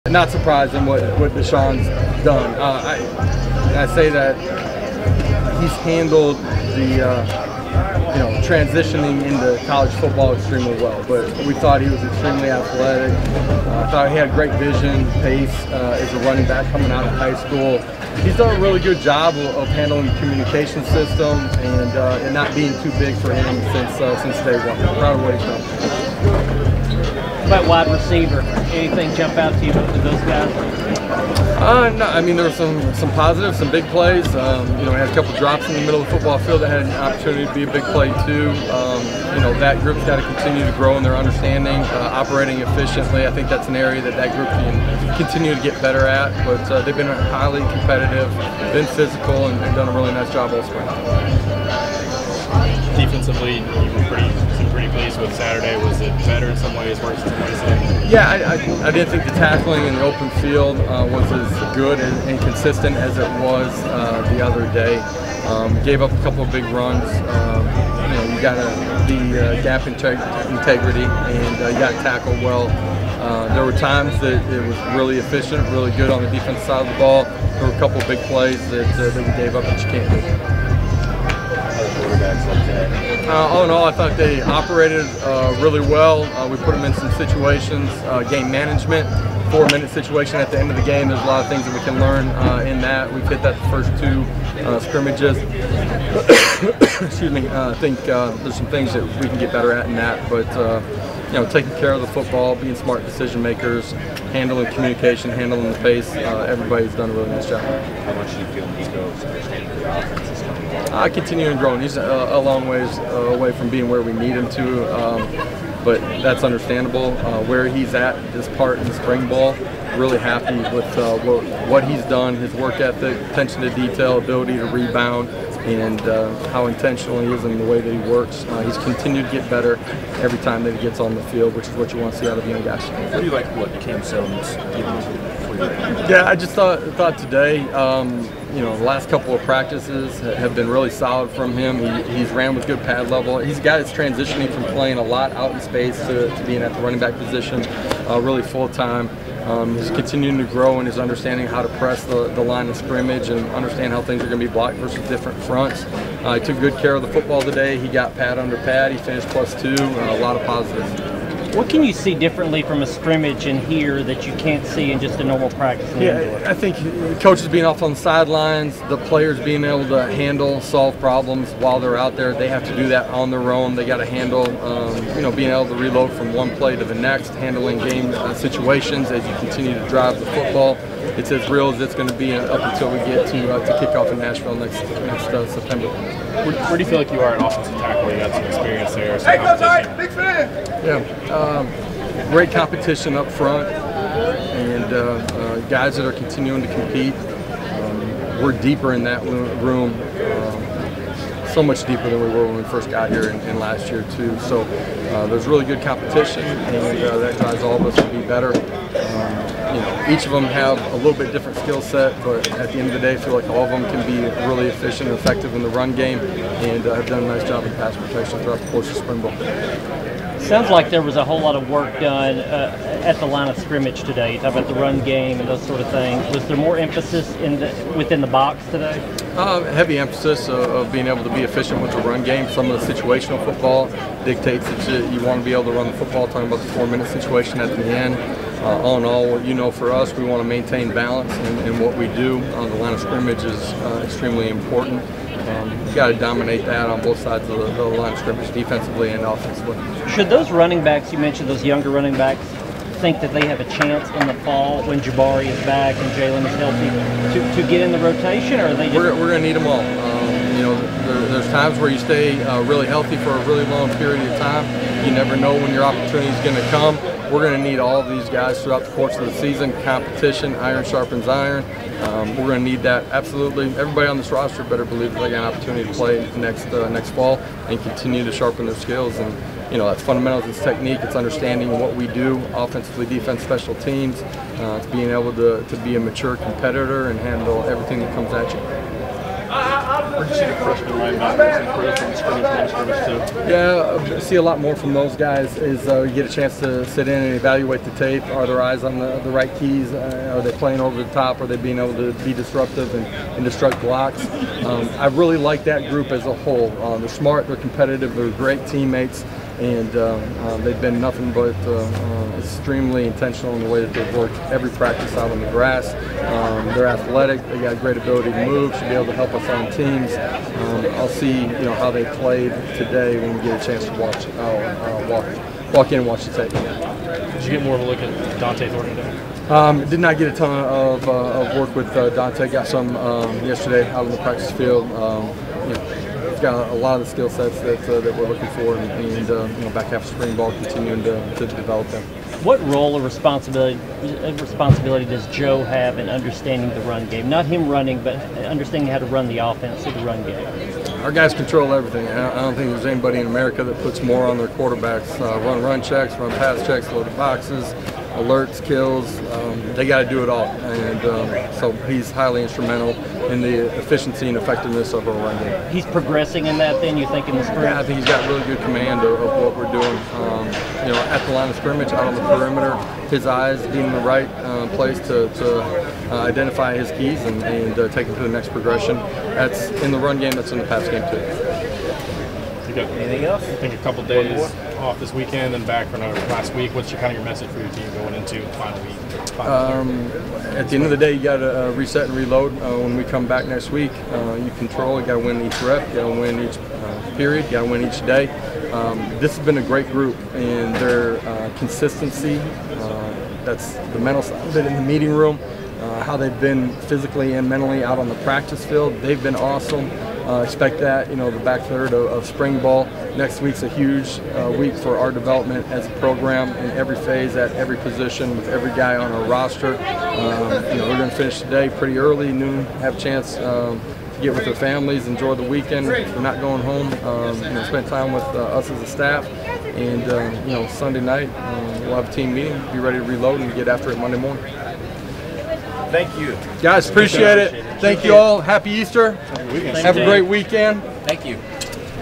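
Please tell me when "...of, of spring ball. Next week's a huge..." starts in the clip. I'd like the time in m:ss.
6:51.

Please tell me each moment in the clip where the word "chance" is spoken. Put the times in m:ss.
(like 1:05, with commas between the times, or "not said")
4:13, 4:56, 5:23, 7:02.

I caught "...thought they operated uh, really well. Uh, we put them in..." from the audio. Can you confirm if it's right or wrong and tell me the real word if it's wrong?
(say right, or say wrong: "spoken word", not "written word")
right.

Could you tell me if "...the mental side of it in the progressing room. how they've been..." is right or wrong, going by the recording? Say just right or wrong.
wrong.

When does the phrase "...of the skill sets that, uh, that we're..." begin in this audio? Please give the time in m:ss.
5:36.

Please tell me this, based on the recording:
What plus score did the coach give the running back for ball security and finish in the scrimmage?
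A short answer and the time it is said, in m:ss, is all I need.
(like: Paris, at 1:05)
plus 2, at 2:39.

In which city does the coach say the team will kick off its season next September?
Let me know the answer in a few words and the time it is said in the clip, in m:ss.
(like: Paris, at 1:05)
Nashville, at 3:04.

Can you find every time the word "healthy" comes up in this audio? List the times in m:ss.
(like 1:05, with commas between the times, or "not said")
4:16, 4:22.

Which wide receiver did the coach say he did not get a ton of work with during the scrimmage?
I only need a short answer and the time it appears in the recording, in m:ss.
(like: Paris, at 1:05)
Dont'e Thornton, at 5:28.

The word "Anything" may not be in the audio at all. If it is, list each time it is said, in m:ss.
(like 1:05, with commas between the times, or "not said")
0:28, 6:22.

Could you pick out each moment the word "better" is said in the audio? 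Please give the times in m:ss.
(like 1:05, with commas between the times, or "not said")
0:45, 0:56, 1:39, 2:09, 3:28, 4:34.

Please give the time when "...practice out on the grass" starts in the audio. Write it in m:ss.
5:14.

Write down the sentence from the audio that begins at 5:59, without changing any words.
Um, they got to do it all, and um, so he's highly instrumental in the efficiency and effectiveness of our run game.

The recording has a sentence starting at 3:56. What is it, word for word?
Talking about the four-minute situation at the end.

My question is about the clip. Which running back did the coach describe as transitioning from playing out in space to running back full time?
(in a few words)
Cam Seldon.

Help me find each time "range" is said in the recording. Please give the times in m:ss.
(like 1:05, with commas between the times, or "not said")
not said.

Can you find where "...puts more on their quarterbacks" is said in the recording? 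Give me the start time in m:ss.
5:53.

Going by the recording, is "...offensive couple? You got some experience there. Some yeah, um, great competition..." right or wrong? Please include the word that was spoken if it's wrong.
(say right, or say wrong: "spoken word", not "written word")
wrong: "tackle", not "couple".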